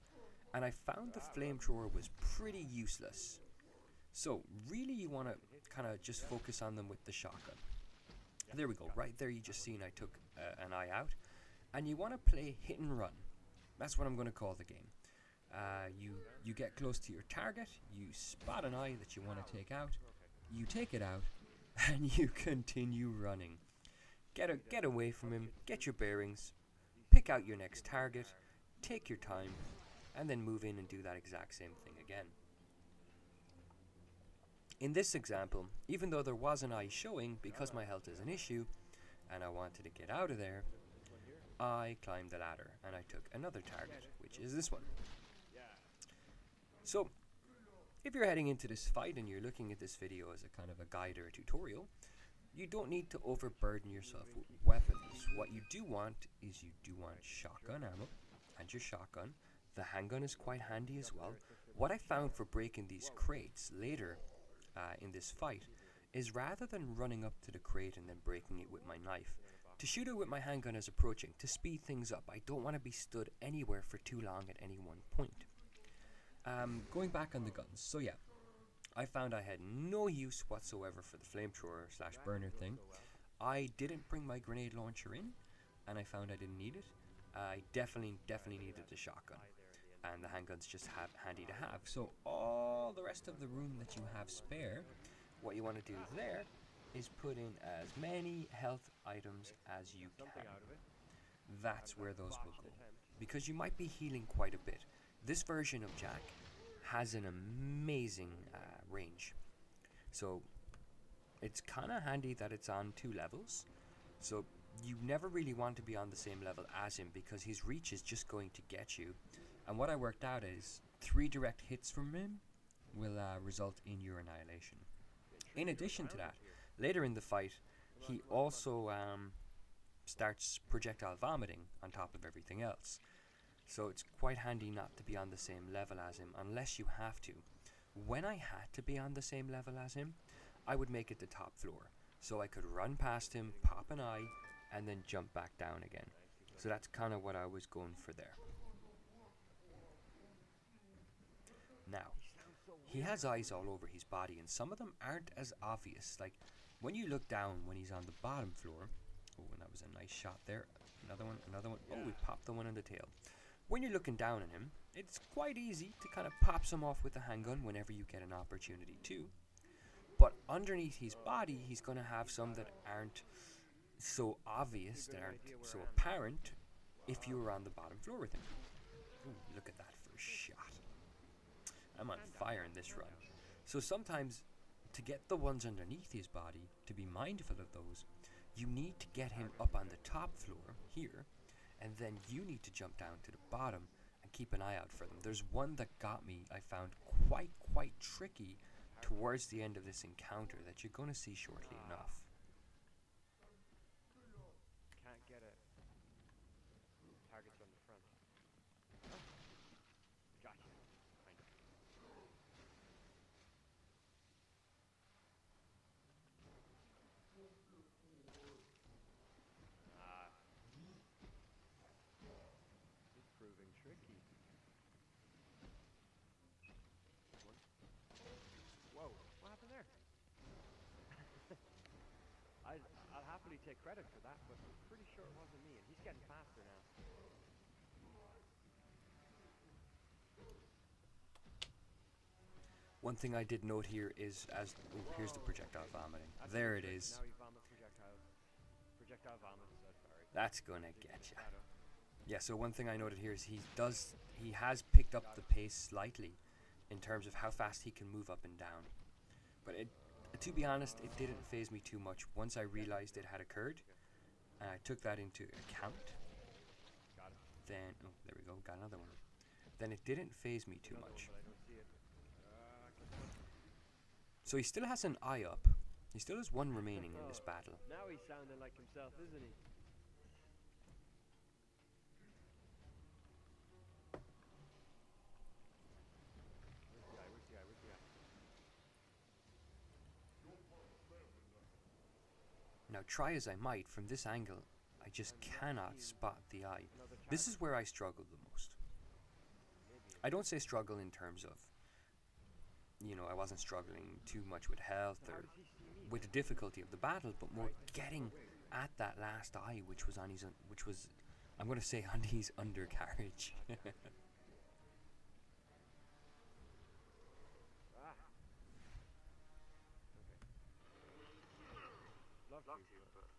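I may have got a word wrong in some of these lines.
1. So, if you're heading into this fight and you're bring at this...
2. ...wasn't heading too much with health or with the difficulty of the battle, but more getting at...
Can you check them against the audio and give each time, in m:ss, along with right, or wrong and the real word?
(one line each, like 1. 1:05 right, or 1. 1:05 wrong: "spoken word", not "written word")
1. 0:46 wrong: "looking", not "bring"
2. 5:03 wrong: "struggling", not "heading".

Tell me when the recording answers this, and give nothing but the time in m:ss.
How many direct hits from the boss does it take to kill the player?
2:01.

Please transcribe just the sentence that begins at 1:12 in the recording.
I don't want to be stood anywhere for too long at any one point.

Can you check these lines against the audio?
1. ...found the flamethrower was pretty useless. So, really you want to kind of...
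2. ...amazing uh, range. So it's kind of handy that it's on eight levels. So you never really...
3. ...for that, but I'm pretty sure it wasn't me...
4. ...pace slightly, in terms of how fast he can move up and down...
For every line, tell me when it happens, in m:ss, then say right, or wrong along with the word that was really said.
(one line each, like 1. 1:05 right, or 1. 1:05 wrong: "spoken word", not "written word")
1. 0:00 right
2. 1:47 wrong: "two", not "eight"
3. 3:54 right
4. 4:15 right.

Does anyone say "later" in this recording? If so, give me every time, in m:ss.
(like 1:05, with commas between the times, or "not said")
1:03, 2:06.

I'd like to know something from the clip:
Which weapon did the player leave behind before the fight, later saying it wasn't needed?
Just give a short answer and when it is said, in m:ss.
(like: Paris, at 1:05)
grenade launcher, at 1:24.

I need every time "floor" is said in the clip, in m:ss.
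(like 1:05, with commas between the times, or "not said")
2:21, 2:38, 2:57, 3:10.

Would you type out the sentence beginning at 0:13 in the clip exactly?
That's what I'm going to call the game.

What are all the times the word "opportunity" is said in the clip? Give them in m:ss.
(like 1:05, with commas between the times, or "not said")
2:48.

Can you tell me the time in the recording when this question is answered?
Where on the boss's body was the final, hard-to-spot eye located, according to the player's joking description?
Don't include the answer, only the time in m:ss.
5:12.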